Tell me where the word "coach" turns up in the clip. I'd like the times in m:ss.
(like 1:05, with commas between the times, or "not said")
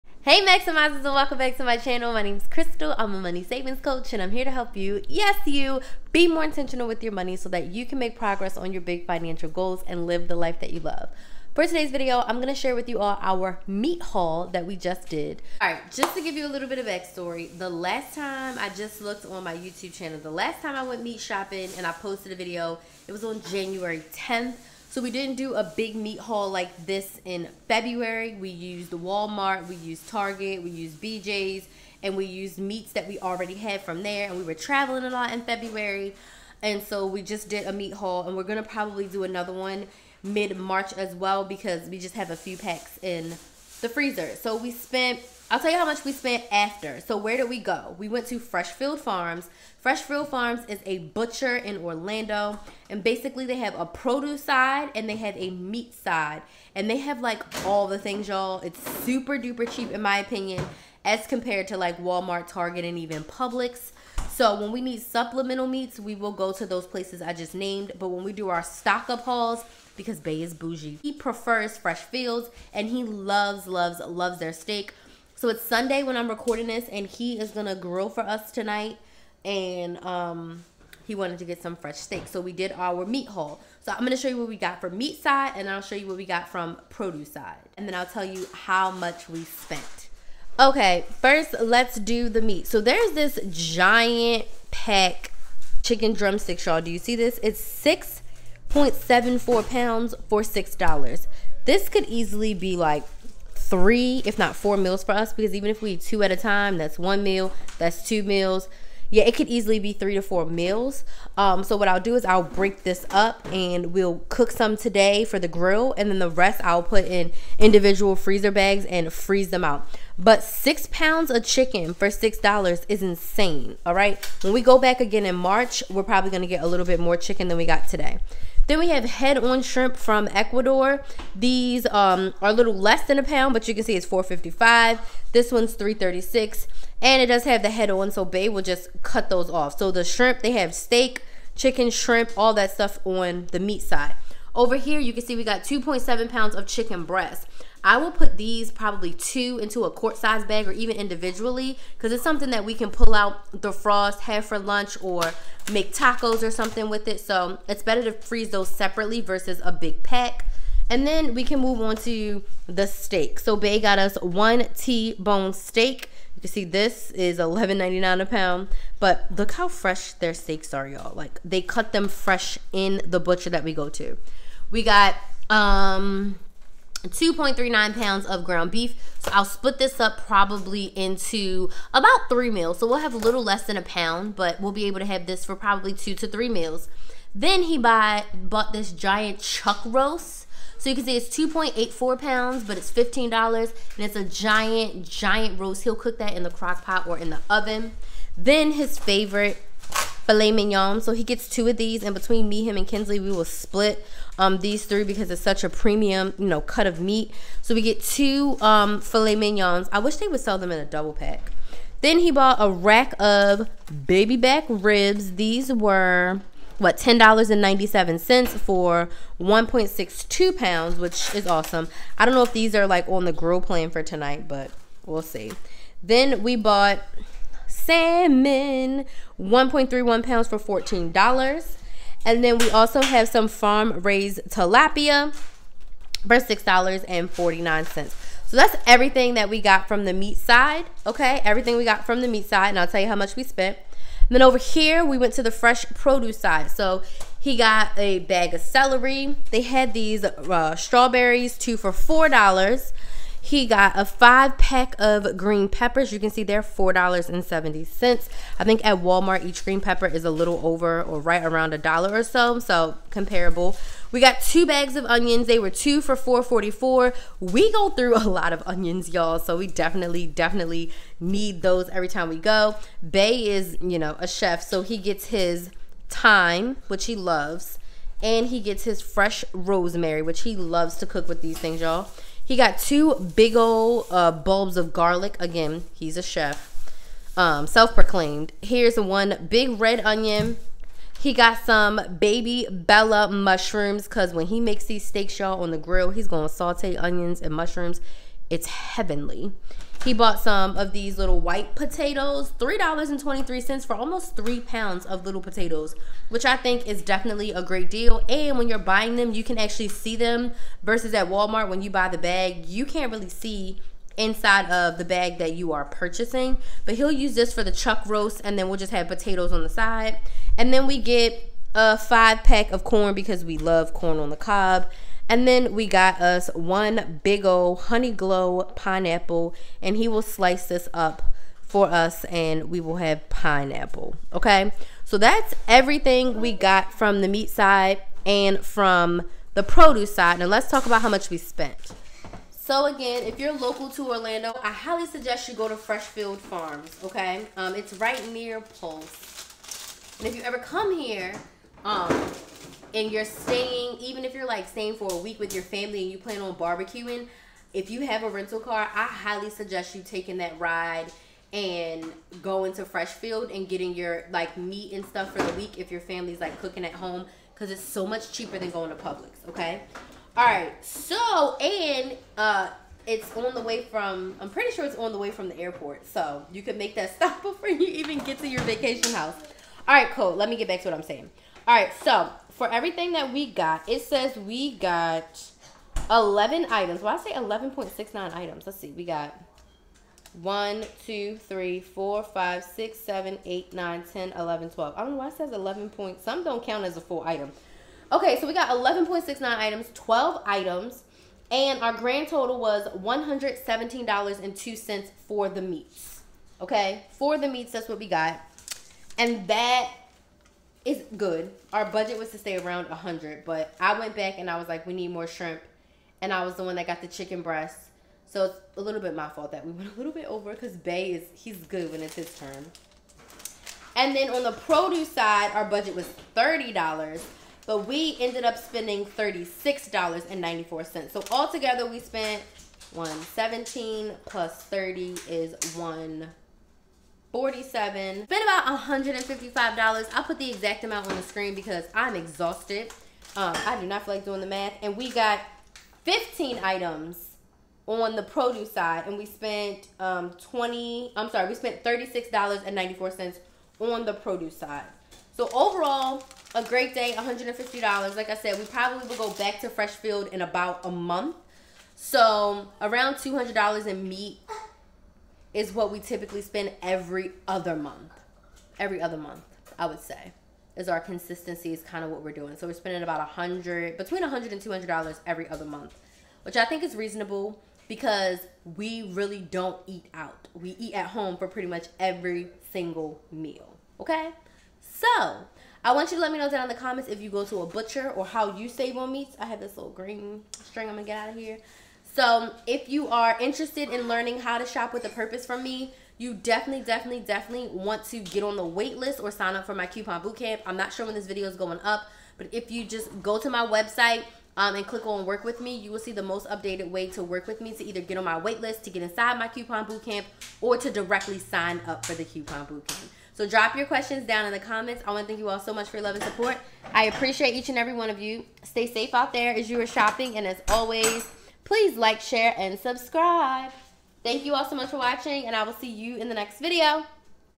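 0:03.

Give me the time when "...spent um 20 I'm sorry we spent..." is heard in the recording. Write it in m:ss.
7:29.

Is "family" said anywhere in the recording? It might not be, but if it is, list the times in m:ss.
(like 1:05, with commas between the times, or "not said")
5:55, 6:06.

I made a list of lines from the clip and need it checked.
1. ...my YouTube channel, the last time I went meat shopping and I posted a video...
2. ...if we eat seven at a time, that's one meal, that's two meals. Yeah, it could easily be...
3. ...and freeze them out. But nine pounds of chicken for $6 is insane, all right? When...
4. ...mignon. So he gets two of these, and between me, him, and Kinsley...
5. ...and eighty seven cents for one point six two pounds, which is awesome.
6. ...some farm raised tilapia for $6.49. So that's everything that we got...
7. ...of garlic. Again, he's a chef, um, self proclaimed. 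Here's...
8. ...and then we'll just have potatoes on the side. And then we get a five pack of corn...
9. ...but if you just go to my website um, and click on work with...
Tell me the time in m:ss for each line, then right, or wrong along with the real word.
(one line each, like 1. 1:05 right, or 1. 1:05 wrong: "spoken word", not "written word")
1. 0:19 right
2. 1:45 wrong: "two", not "seven"
3. 1:58 wrong: "six", not "nine"
4. 3:20 right
5. 3:37 wrong: "ninety", not "eighty"
6. 3:53 right
7. 4:44 right
8. 5:18 right
9. 8:22 right.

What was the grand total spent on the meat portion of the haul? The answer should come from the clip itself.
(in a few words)
$117.02.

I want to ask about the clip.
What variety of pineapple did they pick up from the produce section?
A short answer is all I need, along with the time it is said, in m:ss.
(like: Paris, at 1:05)
honey glow, at 5:27.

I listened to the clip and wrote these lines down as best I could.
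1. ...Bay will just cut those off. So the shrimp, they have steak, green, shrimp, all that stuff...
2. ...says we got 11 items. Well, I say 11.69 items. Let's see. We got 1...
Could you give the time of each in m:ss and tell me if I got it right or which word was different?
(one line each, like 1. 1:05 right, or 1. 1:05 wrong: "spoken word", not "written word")
1. 2:18 wrong: "chicken", not "green"
2. 6:24 right.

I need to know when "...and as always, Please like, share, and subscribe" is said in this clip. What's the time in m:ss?
8:40.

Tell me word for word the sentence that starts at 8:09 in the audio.
I have this little green string I'm gonna get out of here.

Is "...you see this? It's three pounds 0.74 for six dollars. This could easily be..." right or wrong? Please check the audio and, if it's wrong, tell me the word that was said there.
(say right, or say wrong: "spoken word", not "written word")
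wrong: "six", not "three".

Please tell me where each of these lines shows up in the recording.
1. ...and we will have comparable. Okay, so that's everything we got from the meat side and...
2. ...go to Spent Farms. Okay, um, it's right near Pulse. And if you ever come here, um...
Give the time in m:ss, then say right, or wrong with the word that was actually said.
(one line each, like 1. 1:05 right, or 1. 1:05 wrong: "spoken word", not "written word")
1. 5:32 wrong: "pineapple", not "comparable"
2. 5:45 wrong: "Freshfield", not "Spent".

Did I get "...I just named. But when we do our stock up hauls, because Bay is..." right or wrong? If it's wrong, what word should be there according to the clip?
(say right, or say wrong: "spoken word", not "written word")
right.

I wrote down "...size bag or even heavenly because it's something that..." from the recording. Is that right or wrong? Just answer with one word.
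wrong.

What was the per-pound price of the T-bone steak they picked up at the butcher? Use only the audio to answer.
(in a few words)
$11.99.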